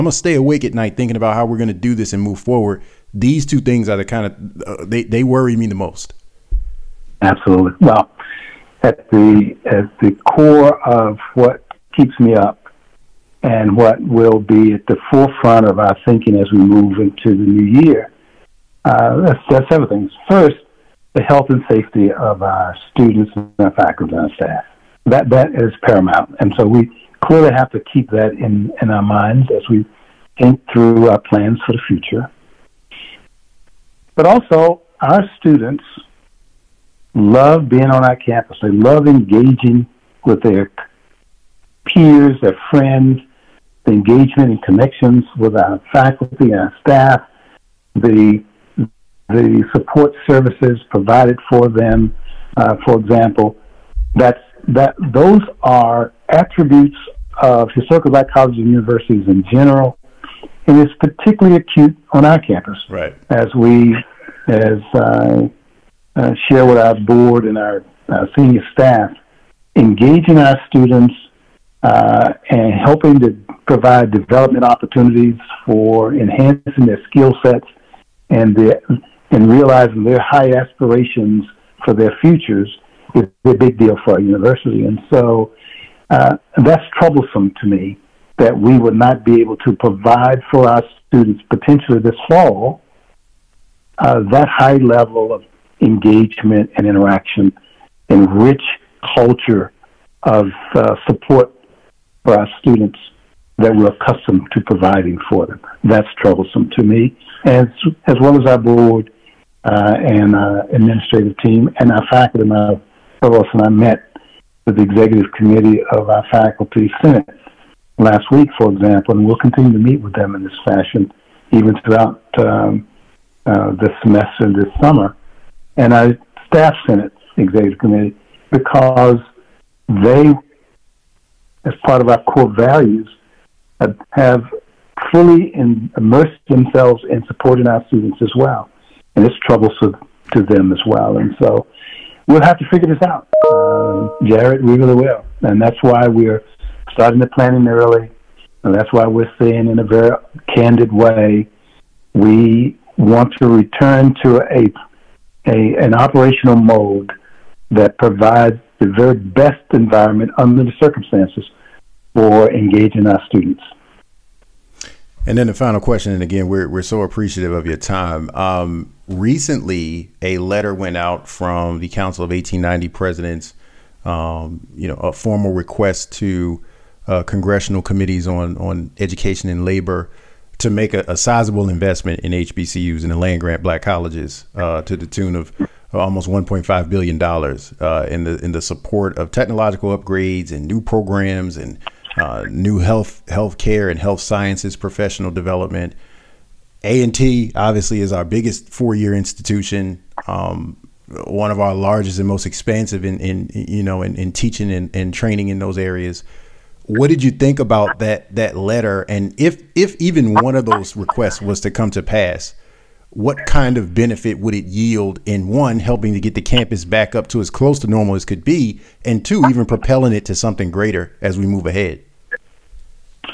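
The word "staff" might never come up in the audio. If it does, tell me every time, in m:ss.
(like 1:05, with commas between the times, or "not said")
0:24, 0:46, 1:08, 2:06.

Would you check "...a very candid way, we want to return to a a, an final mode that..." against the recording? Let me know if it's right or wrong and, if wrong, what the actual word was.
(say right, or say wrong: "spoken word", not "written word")
wrong: "operational", not "final".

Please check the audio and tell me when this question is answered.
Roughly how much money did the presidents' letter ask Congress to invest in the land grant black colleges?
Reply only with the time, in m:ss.
3:05.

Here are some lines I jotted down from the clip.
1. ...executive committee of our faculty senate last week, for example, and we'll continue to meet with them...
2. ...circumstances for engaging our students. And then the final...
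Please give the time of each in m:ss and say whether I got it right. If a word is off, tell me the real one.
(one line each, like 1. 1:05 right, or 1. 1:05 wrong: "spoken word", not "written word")
1. 1:54 right
2. 2:40 right.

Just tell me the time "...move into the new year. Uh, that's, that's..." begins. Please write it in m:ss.
0:16.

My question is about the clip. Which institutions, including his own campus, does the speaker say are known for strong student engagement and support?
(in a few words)
historical black colleges and universities.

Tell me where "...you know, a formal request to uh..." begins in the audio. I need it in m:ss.
2:54.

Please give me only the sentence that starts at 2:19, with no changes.
And it's troublesome to them as well.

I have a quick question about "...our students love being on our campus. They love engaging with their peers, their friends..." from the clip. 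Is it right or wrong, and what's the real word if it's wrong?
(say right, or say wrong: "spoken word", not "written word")
right.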